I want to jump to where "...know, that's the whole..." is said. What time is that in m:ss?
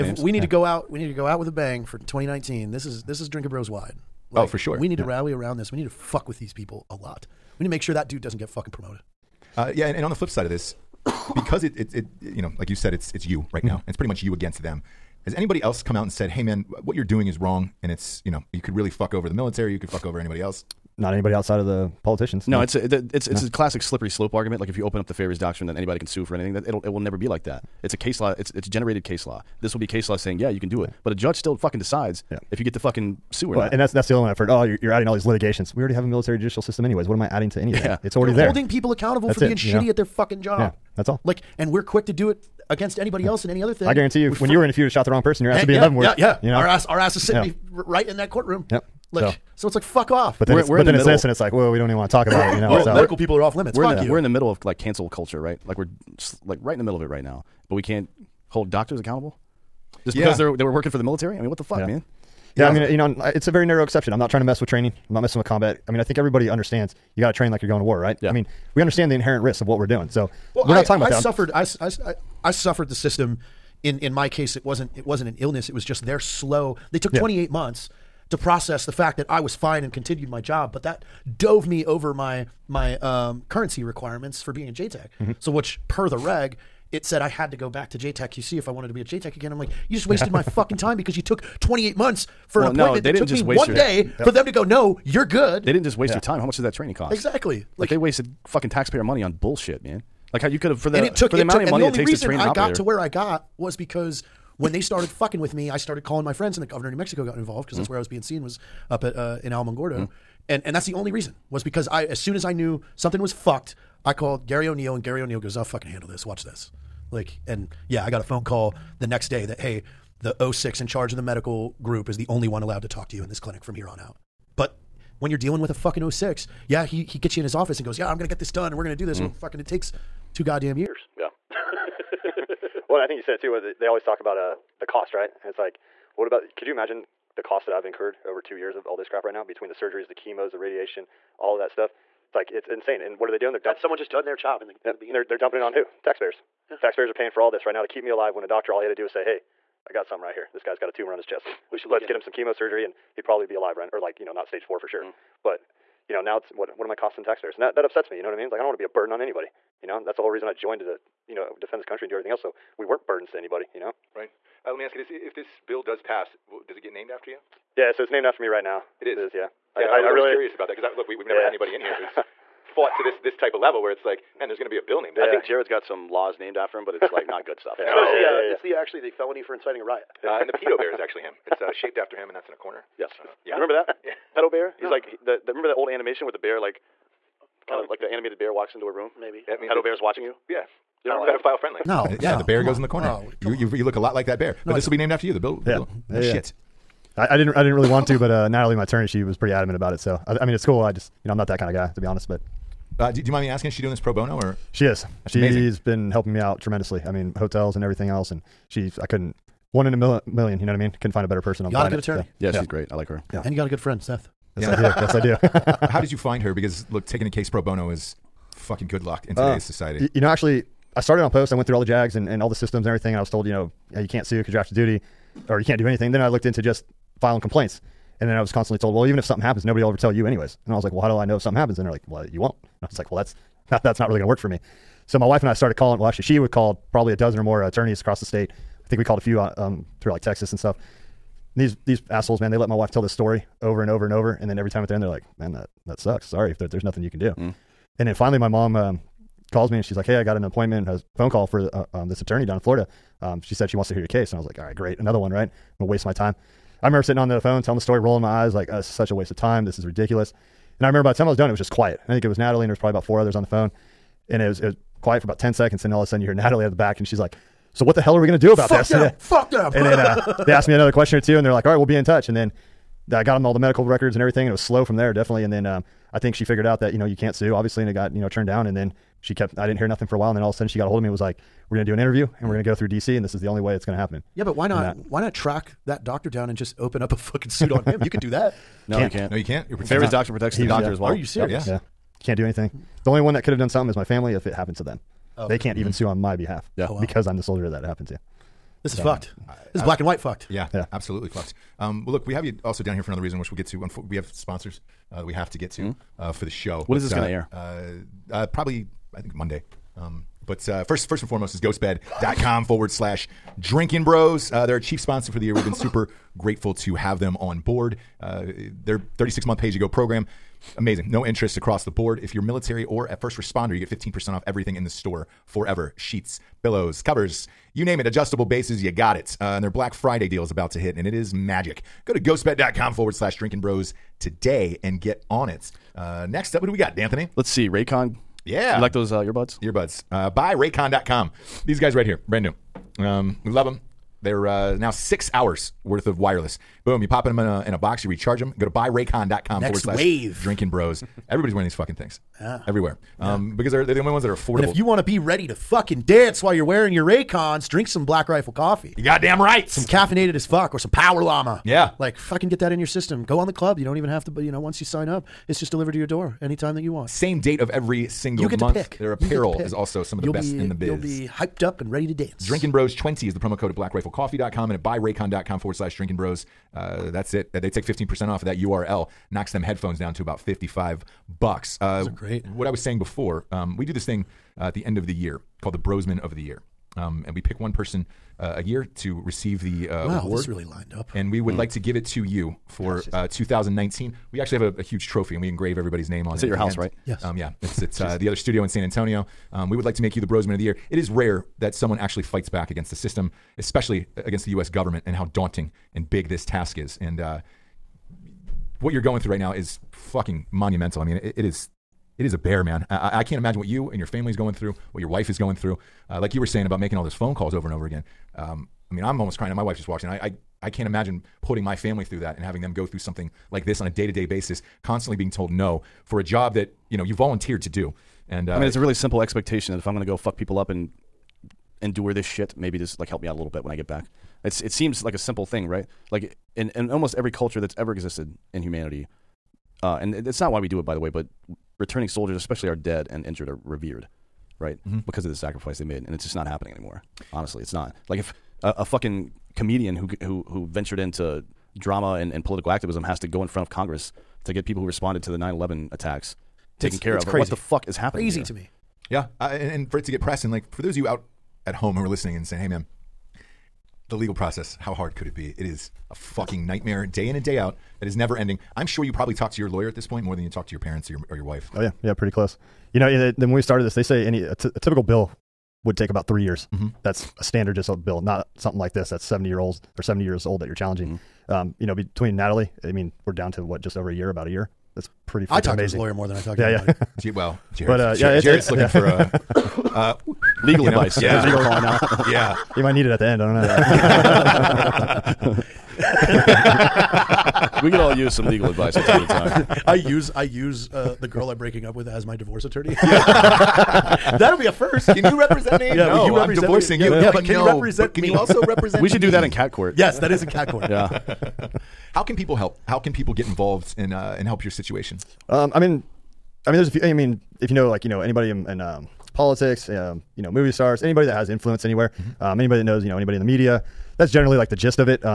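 2:39.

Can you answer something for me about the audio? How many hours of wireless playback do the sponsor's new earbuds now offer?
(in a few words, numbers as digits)
6 hours.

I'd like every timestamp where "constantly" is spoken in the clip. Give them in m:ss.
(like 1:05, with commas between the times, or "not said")
3:48, 7:04.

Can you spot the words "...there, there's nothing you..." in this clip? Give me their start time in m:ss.
4:06.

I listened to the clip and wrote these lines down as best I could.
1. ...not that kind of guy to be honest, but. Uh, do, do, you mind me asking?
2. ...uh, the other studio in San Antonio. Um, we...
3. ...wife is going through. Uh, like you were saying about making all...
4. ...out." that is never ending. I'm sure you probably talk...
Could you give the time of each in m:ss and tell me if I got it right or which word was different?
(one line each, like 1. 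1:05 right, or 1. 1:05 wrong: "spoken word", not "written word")
1. 3:21 right
2. 6:37 right
3. 6:55 right
4. 7:47 right.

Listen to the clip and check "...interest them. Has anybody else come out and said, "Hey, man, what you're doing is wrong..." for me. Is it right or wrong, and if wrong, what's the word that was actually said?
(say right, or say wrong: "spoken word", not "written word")
wrong: "against", not "interest".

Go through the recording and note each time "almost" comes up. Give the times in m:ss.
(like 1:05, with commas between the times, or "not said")
6:59, 7:16.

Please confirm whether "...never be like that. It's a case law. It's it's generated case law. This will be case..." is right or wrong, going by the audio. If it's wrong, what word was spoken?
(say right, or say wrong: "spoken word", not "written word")
right.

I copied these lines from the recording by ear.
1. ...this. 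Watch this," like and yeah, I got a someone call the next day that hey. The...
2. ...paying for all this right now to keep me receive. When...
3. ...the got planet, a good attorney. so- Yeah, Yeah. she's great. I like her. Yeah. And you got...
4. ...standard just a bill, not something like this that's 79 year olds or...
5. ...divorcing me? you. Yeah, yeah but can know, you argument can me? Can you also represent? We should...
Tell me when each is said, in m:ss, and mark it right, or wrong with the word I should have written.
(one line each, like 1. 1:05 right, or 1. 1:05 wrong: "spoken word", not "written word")
1. 1:56 wrong: "phone", not "someone"
2. 2:27 wrong: "alive", not "receive"
3. 3:31 right
4. 7:57 wrong: "70", not "79"
5. 8:26 wrong: "represent", not "argument".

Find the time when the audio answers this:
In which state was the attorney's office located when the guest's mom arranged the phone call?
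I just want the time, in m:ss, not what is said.
4:12.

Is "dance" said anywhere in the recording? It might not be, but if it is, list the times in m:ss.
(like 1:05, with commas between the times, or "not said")
5:56, 6:12.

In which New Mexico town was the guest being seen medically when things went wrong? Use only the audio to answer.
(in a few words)
Alamogordo.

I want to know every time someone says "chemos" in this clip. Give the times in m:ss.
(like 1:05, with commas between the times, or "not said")
2:20, 2:32.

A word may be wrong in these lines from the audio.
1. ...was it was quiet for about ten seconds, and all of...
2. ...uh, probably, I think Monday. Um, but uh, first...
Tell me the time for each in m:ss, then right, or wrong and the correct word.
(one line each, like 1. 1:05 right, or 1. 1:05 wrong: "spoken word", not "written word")
1. 4:24 right
2. 5:08 right.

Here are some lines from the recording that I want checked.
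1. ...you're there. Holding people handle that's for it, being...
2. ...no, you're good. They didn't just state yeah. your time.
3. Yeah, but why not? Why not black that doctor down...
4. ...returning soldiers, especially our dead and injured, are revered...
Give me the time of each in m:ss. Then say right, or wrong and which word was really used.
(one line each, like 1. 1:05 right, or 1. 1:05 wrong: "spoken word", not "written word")
1. 0:38 wrong: "accountable", not "handle"
2. 1:34 wrong: "waste", not "state"
3. 4:44 wrong: "track", not "black"
4. 7:21 right.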